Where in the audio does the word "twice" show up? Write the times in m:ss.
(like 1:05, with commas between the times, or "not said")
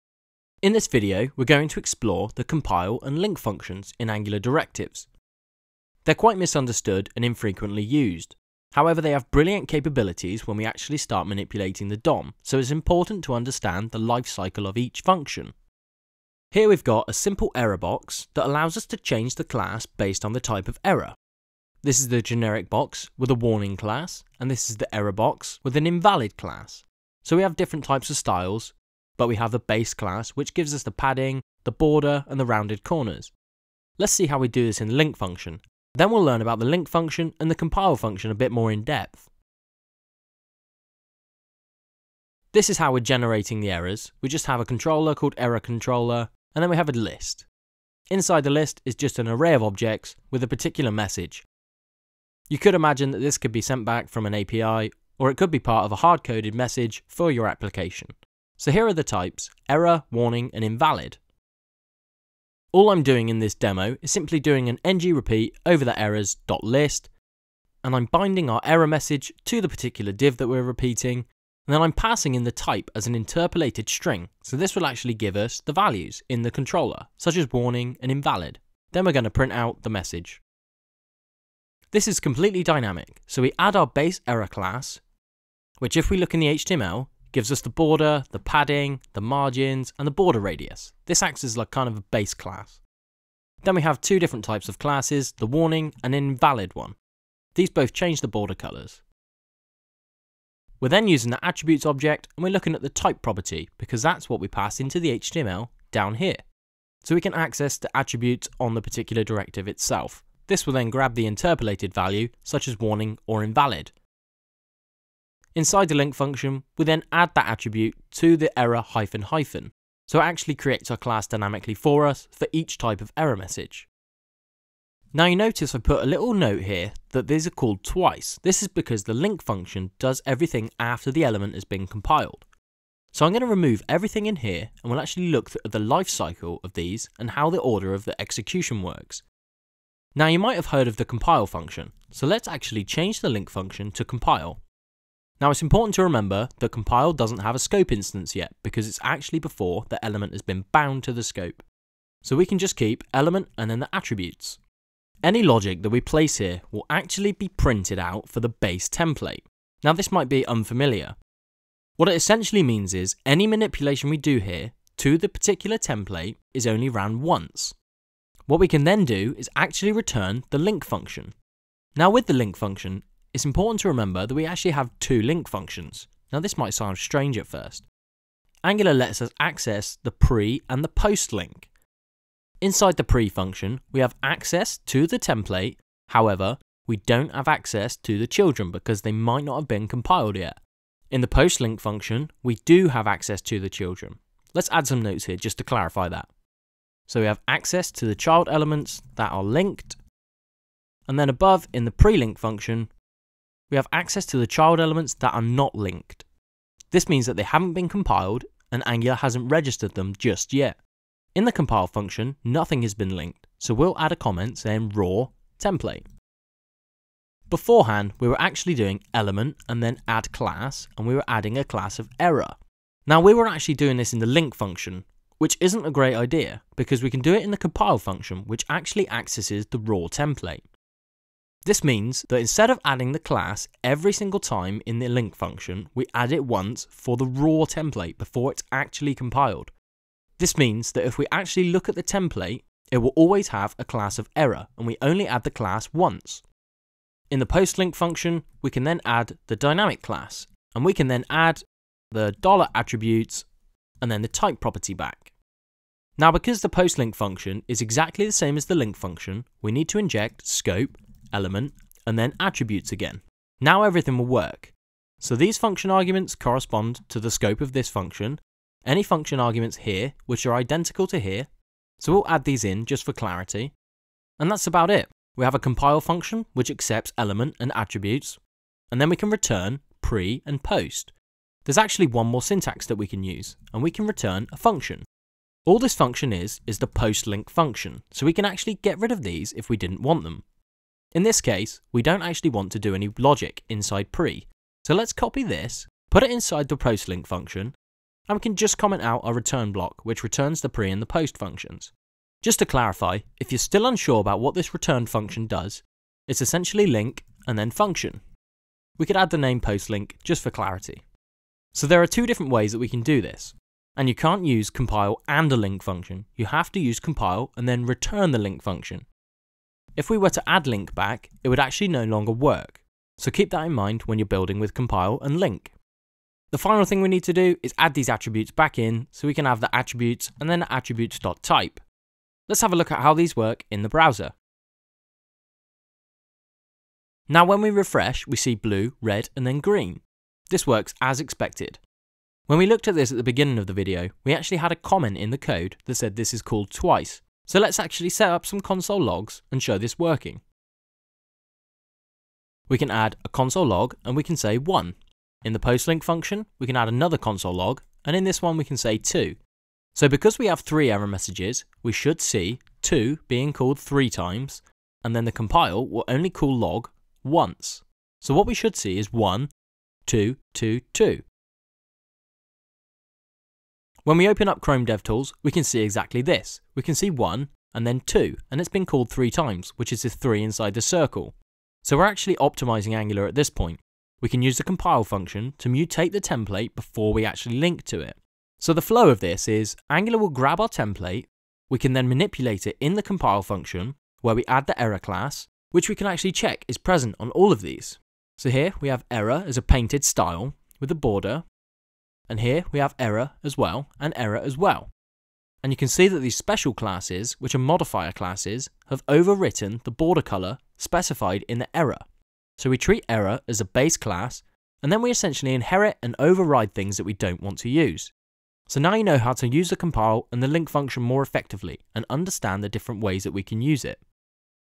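2:07, 5:46.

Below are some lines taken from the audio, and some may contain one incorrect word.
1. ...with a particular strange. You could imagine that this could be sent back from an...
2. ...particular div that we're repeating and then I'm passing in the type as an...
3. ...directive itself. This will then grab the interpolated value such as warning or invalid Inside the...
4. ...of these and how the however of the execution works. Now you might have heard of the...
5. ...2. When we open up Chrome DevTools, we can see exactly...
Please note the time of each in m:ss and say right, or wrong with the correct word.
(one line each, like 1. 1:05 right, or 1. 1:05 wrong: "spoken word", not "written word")
1. 0:50 wrong: "message", not "strange"
2. 1:09 right
3. 1:49 right
4. 2:16 wrong: "order", not "however"
5. 6:10 right.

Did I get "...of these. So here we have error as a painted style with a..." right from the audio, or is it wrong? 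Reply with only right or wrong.
right.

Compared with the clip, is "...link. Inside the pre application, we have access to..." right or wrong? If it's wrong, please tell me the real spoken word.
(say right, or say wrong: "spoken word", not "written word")
wrong: "function", not "application".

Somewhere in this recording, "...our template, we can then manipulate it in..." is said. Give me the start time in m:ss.
6:30.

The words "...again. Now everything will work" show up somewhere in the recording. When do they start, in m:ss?
4:22.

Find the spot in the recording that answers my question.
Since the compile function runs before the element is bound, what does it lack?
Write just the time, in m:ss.
2:27.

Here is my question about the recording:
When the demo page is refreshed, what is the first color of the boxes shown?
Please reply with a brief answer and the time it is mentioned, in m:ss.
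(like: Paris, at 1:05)
blue, at 5:38.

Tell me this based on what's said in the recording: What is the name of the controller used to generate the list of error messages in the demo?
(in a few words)
error controller.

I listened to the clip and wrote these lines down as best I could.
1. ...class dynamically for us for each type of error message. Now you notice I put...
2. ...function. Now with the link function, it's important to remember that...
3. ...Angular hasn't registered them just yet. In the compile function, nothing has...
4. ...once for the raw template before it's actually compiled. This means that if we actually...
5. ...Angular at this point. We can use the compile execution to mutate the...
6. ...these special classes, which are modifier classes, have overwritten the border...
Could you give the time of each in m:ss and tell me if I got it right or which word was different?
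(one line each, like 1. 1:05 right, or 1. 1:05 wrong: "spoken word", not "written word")
1. 2:00 right
2. 2:50 right
3. 3:28 right
4. 3:56 right
5. 6:22 wrong: "function", not "execution"
6. 6:46 right.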